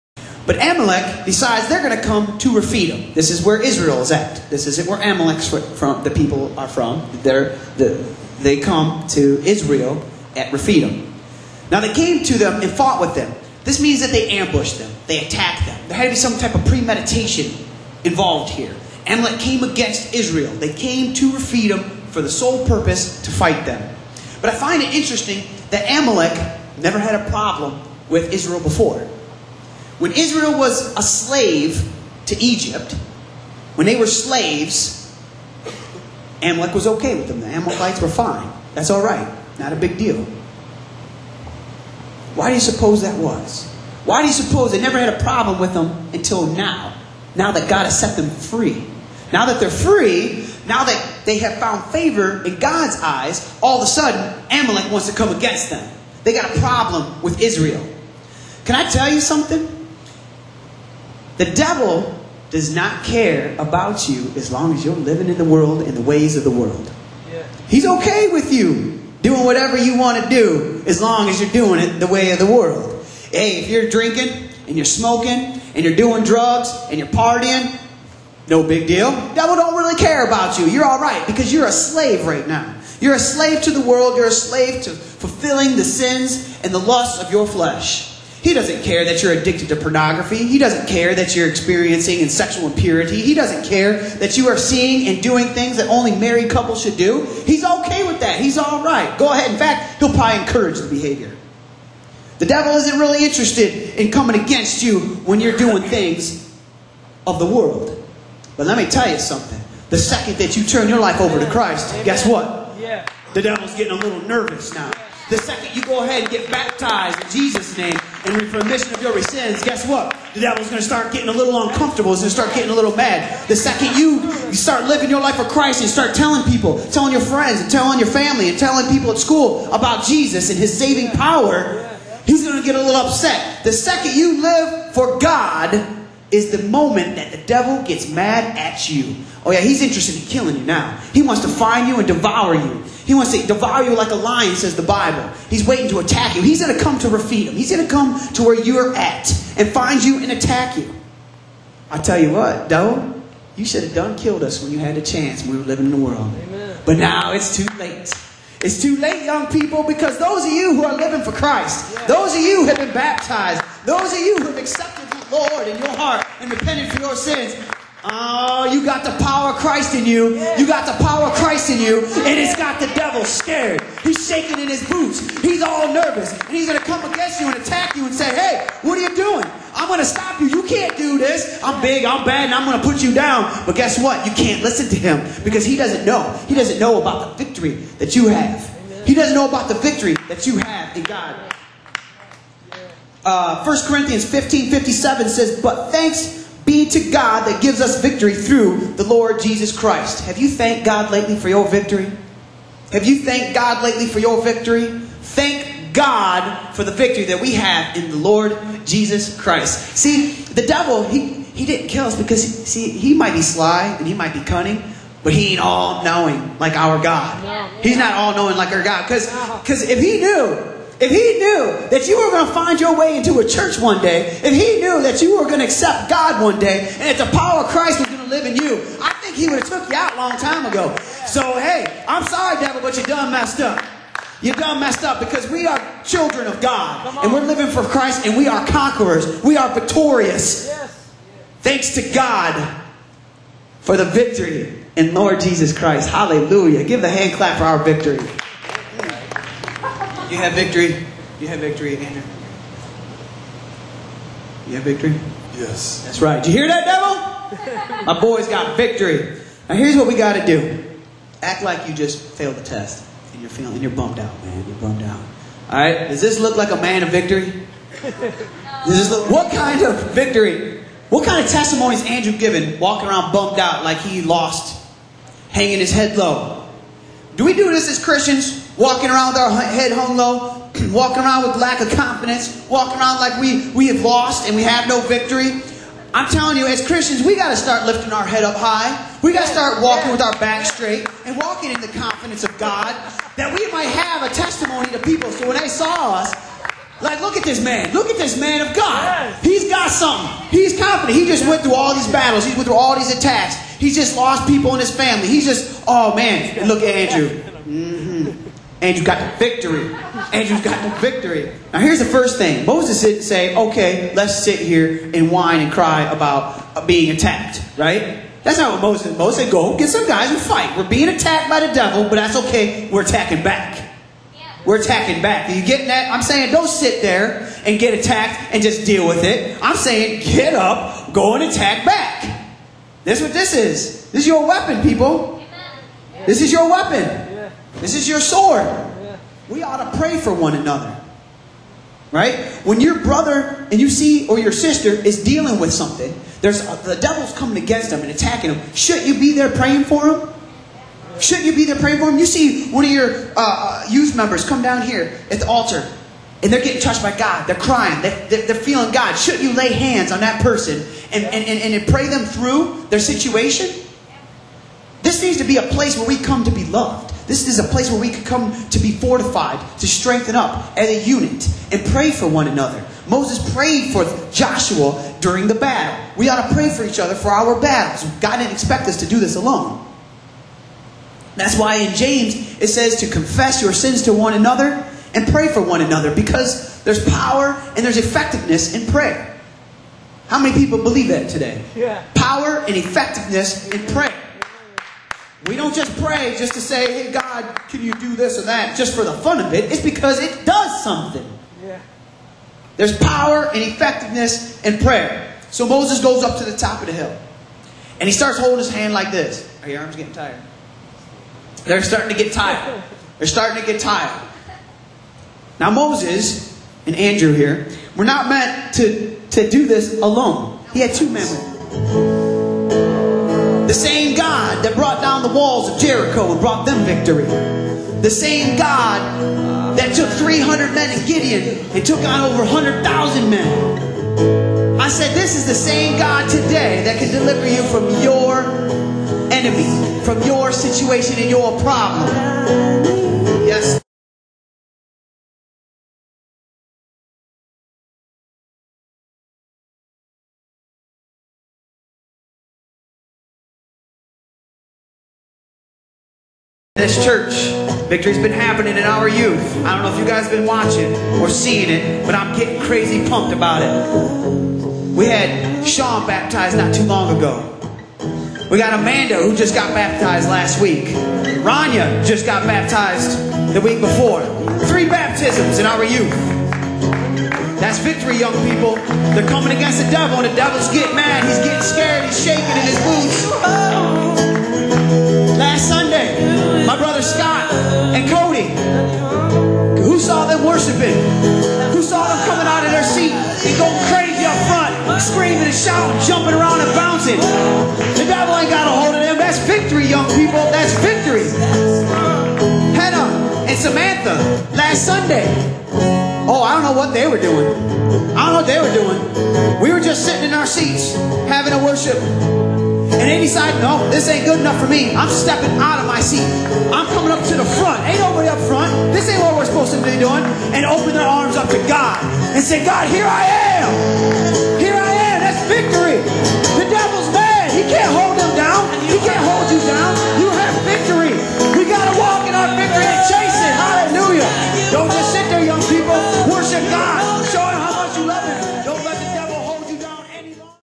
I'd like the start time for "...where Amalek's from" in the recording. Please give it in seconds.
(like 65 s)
4 s.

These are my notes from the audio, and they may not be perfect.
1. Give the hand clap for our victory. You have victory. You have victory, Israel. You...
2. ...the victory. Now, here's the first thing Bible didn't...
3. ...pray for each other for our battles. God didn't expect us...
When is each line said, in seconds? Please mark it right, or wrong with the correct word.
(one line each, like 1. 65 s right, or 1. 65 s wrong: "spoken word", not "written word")
1. 246 s wrong: "Andrew", not "Israel"
2. 310 s wrong: "Moses", not "Bible"
3. 376 s right.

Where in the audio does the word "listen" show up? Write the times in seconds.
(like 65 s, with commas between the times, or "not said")
184 s.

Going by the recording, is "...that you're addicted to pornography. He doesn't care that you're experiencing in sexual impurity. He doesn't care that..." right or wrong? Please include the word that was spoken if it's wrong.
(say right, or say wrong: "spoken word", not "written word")
right.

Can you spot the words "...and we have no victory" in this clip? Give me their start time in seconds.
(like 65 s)
284 s.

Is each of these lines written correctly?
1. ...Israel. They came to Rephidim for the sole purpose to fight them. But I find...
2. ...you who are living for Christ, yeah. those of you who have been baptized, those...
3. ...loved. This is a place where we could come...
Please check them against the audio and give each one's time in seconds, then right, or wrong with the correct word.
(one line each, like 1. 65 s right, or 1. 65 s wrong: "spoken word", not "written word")
1. 20 s right
2. 160 s right
3. 366 s right.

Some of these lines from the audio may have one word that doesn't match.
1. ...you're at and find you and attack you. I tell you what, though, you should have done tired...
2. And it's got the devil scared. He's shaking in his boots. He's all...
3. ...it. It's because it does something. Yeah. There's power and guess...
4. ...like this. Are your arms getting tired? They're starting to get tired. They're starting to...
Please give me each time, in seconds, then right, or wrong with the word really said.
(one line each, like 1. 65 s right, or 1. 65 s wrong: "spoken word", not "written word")
1. 148 s wrong: "killed", not "tired"
2. 171 s right
3. 399 s wrong: "effectiveness", not "guess"
4. 408 s right.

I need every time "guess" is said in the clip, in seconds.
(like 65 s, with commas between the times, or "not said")
112 s, 119 s, 183 s.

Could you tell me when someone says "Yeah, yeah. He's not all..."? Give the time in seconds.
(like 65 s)
217 s.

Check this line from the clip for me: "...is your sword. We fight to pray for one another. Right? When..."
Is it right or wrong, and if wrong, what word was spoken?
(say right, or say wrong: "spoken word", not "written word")
wrong: "ought", not "fight".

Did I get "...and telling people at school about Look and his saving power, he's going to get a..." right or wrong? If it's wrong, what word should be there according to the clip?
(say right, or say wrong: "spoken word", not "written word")
wrong: "Jesus", not "Look".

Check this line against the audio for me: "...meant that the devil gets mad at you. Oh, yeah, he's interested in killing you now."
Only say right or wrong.
wrong.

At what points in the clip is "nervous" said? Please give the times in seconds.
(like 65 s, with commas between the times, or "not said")
114 s, 175 s.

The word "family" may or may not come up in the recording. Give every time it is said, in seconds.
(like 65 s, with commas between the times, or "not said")
128 s, 304 s.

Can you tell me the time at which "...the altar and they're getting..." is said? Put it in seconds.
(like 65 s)
355 s.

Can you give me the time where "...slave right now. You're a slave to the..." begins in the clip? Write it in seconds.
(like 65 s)
81 s.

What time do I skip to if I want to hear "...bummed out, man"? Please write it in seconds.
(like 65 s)
263 s.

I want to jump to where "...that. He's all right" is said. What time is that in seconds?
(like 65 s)
98 s.